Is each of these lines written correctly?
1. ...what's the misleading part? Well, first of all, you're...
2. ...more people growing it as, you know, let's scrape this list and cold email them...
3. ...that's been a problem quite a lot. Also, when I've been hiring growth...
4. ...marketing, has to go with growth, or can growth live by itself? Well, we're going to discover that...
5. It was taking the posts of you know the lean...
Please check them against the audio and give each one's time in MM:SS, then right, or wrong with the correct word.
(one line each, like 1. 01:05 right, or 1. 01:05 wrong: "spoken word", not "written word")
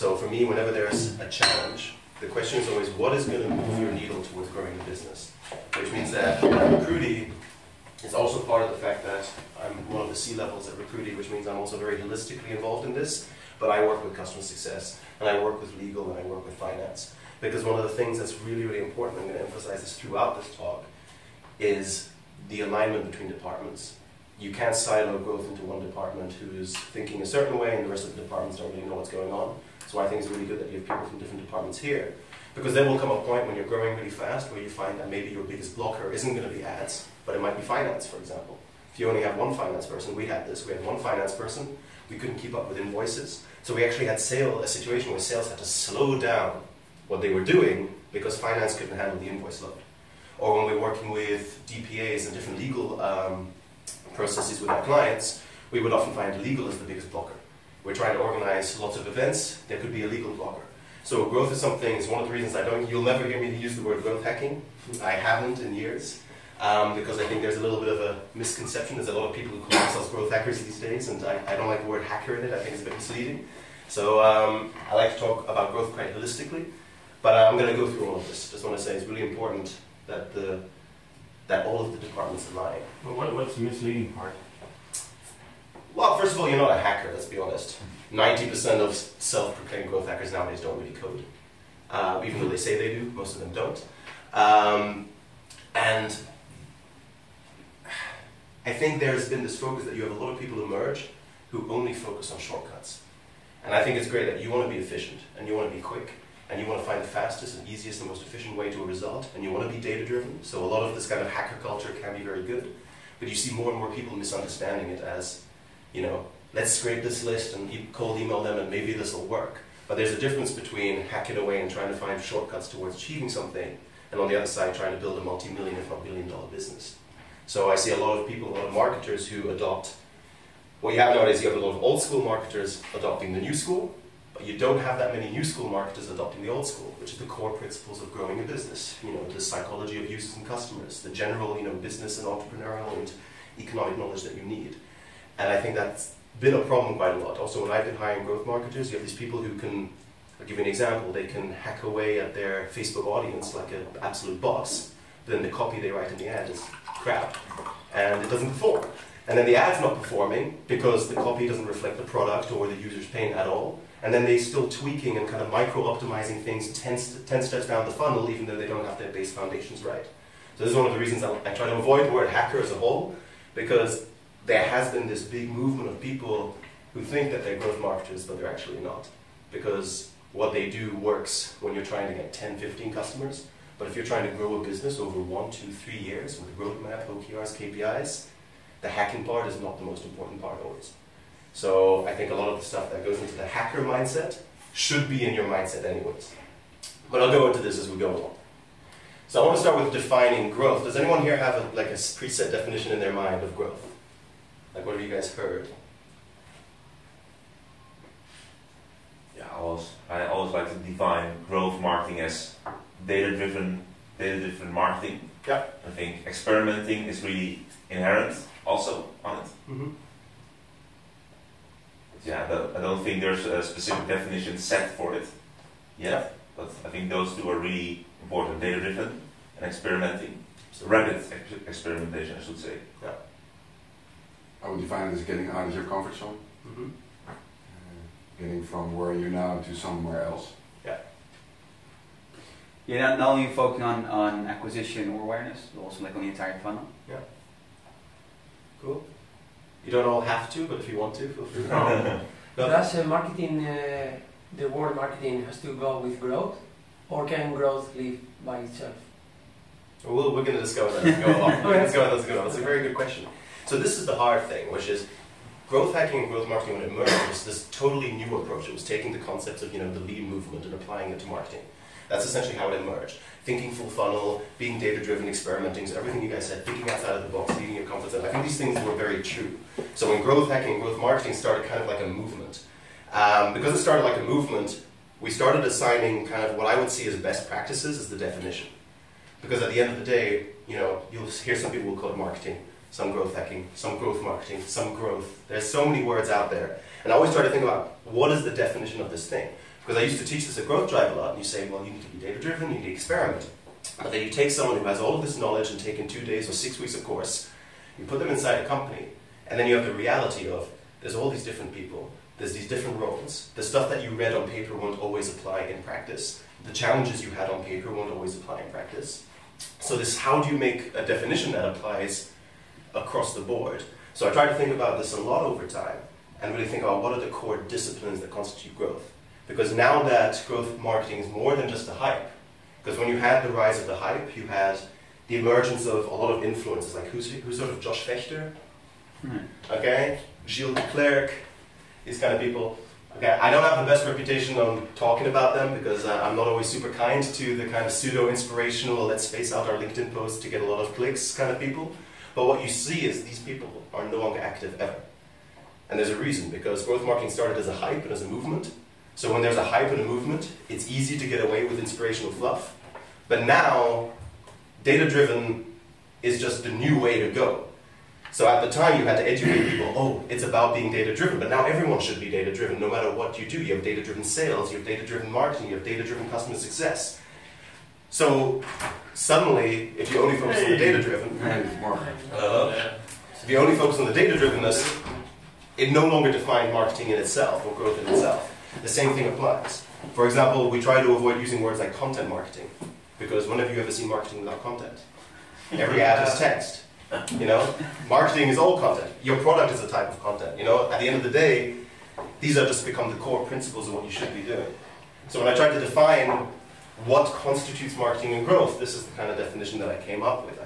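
1. 01:23 right
2. 01:53 wrong: "misunderstanding", not "growing"
3. 02:25 right
4. 04:14 right
5. 04:28 wrong: "concepts", not "posts".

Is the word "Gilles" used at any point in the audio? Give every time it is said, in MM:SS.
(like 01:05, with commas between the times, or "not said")
05:40.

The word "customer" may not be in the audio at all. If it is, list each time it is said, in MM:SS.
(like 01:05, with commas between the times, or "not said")
00:14, 02:20, 03:02, 06:16.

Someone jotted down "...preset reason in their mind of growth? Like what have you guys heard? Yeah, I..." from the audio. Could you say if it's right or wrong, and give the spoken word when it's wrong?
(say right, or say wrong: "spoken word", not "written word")
wrong: "definition", not "reason".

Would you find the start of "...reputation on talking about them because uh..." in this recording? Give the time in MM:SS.
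05:44.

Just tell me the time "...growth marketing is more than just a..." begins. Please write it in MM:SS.
05:30.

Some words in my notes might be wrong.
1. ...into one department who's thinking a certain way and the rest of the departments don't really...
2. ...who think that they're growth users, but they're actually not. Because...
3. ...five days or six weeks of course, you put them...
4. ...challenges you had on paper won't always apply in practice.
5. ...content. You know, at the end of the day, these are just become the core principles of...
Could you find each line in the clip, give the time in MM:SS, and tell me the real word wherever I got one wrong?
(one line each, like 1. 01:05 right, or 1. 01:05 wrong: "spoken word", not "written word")
1. 00:25 right
2. 02:56 wrong: "marketers", not "users"
3. 05:06 wrong: "two", not "five"
4. 05:16 right
5. 06:40 right.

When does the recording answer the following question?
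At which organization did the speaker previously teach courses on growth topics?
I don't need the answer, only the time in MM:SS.
05:00.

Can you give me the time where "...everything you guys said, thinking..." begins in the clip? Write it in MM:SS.
04:35.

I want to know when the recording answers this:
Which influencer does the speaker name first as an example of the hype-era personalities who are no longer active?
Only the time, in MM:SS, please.
05:37.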